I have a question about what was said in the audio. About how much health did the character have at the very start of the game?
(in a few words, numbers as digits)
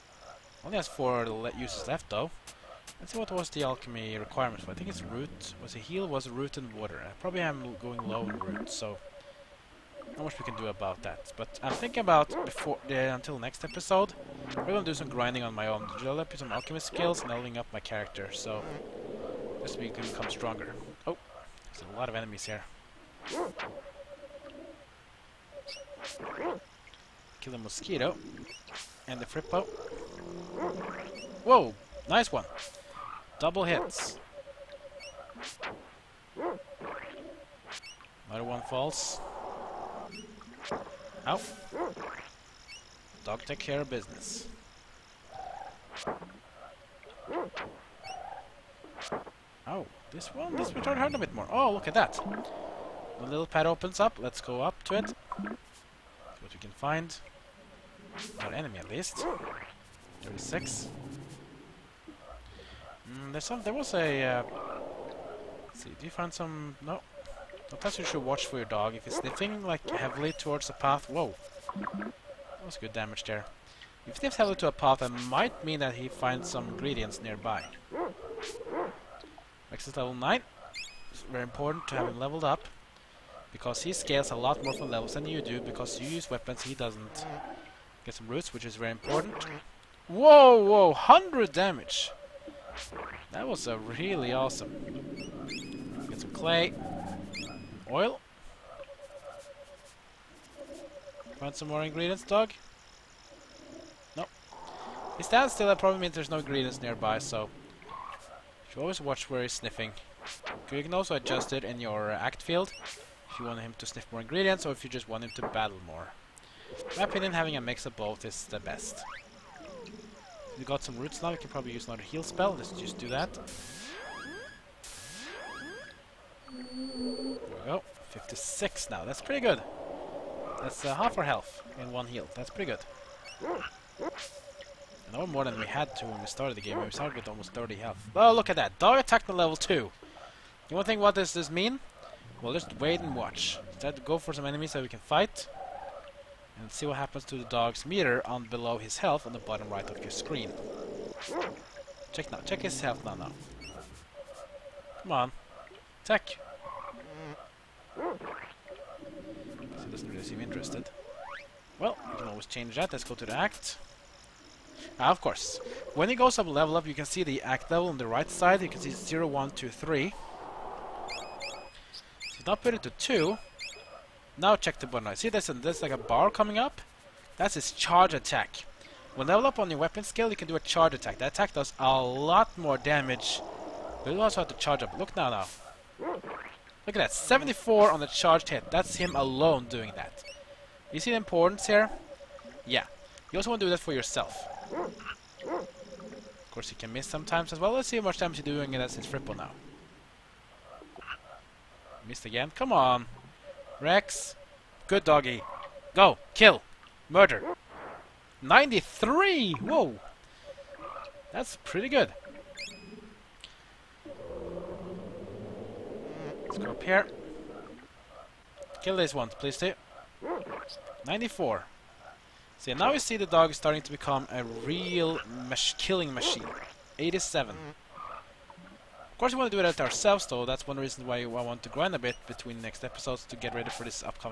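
30.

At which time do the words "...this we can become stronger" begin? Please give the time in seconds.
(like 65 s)
19 s.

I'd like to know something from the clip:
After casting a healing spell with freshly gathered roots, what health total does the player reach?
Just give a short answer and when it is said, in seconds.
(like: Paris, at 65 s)
56, at 128 s.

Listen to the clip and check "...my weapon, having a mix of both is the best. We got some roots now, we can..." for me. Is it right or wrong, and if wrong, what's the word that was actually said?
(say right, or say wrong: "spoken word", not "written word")
wrong: "opinion", not "weapon".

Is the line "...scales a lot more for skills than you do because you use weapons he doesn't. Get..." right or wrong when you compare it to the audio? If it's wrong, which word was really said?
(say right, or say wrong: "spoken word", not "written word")
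wrong: "levels", not "skills".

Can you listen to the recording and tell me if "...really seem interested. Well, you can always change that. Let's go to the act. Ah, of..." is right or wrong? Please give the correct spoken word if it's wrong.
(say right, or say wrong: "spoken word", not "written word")
right.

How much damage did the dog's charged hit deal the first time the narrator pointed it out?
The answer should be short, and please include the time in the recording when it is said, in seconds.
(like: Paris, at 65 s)
74, at 187 s.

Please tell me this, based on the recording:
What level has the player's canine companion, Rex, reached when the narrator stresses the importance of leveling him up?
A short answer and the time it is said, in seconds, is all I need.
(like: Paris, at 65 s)
9, at 79 s.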